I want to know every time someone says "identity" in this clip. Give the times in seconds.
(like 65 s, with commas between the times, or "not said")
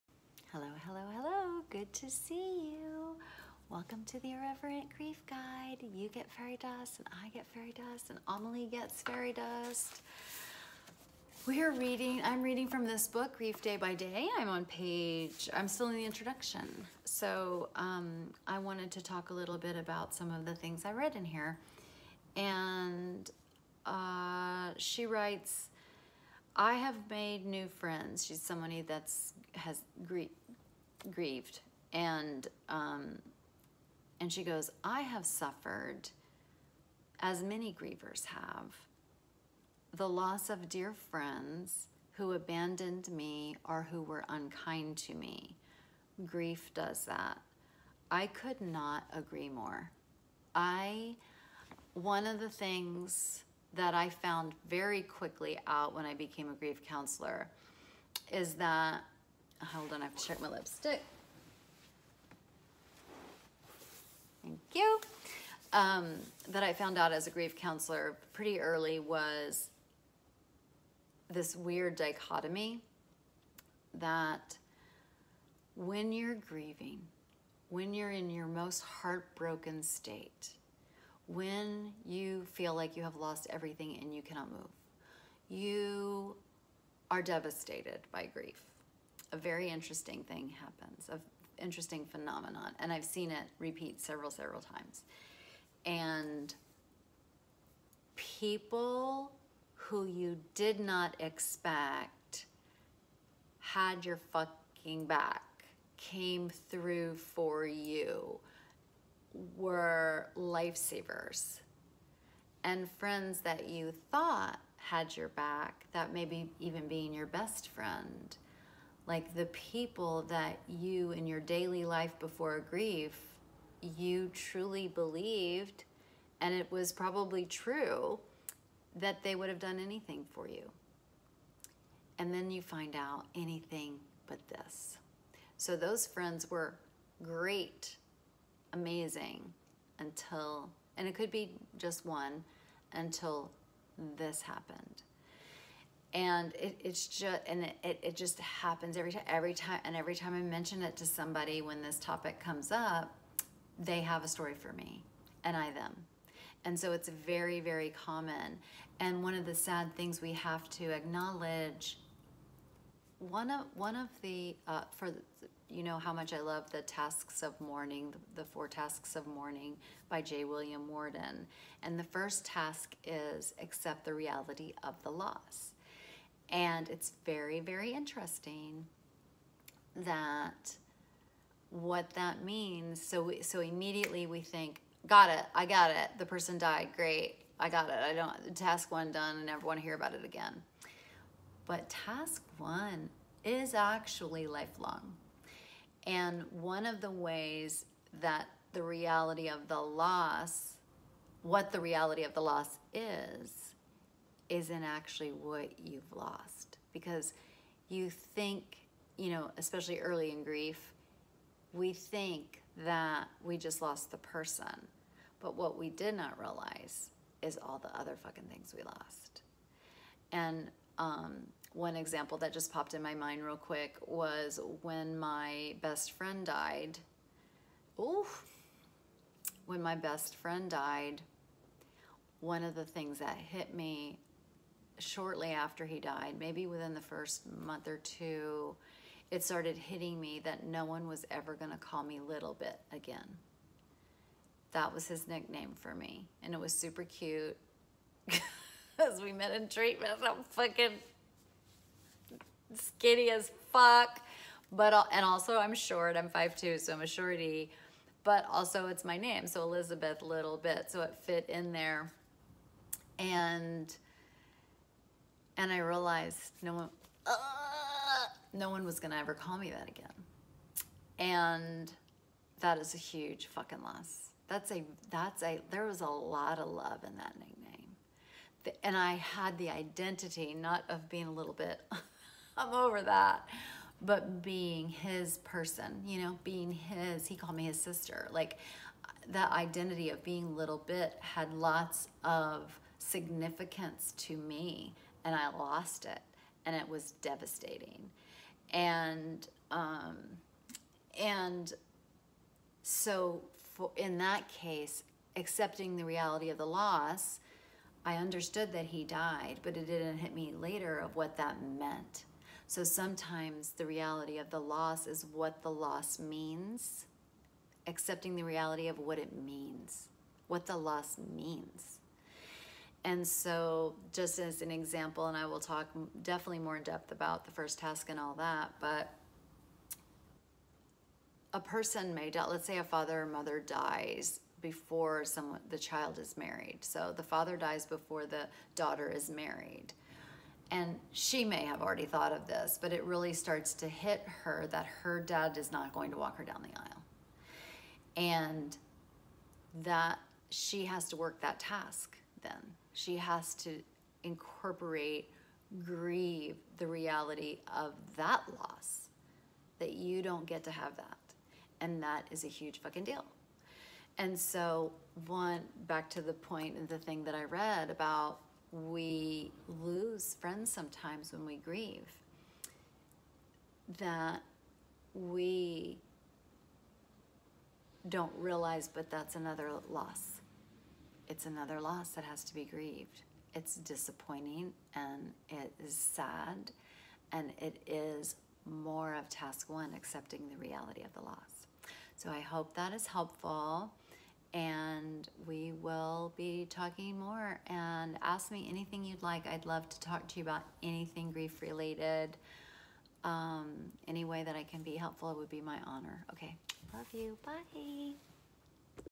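279 s, 289 s.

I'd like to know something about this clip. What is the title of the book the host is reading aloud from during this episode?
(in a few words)
Grief Day by Day.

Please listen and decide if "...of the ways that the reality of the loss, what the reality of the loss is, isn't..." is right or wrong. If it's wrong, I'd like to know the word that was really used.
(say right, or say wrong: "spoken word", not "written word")
right.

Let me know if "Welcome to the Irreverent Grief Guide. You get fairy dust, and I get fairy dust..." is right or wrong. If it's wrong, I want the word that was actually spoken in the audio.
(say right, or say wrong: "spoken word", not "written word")
right.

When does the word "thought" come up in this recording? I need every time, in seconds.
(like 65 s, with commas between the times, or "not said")
114 s, 342 s.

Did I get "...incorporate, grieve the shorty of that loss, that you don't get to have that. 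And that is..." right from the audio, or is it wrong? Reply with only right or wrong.
wrong.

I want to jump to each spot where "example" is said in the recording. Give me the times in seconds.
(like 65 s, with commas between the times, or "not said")
221 s, 324 s.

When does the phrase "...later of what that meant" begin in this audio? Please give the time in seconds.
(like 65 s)
310 s.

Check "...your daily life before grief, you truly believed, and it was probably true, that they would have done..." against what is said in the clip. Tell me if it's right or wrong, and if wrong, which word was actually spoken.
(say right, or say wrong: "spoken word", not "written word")
right.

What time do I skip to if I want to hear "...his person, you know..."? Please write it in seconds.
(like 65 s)
284 s.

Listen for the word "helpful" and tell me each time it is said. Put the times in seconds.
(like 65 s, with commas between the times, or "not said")
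393 s, 404 s.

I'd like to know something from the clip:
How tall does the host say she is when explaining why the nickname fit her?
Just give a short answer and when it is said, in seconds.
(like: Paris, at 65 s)
5'2", at 256 s.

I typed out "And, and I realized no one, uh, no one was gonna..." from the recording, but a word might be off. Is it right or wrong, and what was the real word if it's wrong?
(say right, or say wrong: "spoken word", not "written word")
right.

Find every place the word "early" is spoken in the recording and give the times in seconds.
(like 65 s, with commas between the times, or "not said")
68 s, 209 s.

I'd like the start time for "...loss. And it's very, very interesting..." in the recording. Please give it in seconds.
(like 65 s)
175 s.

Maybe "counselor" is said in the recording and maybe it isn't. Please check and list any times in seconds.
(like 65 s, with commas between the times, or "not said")
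56 s, 67 s.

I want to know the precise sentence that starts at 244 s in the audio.
That was his nickname for me, and it was super cute.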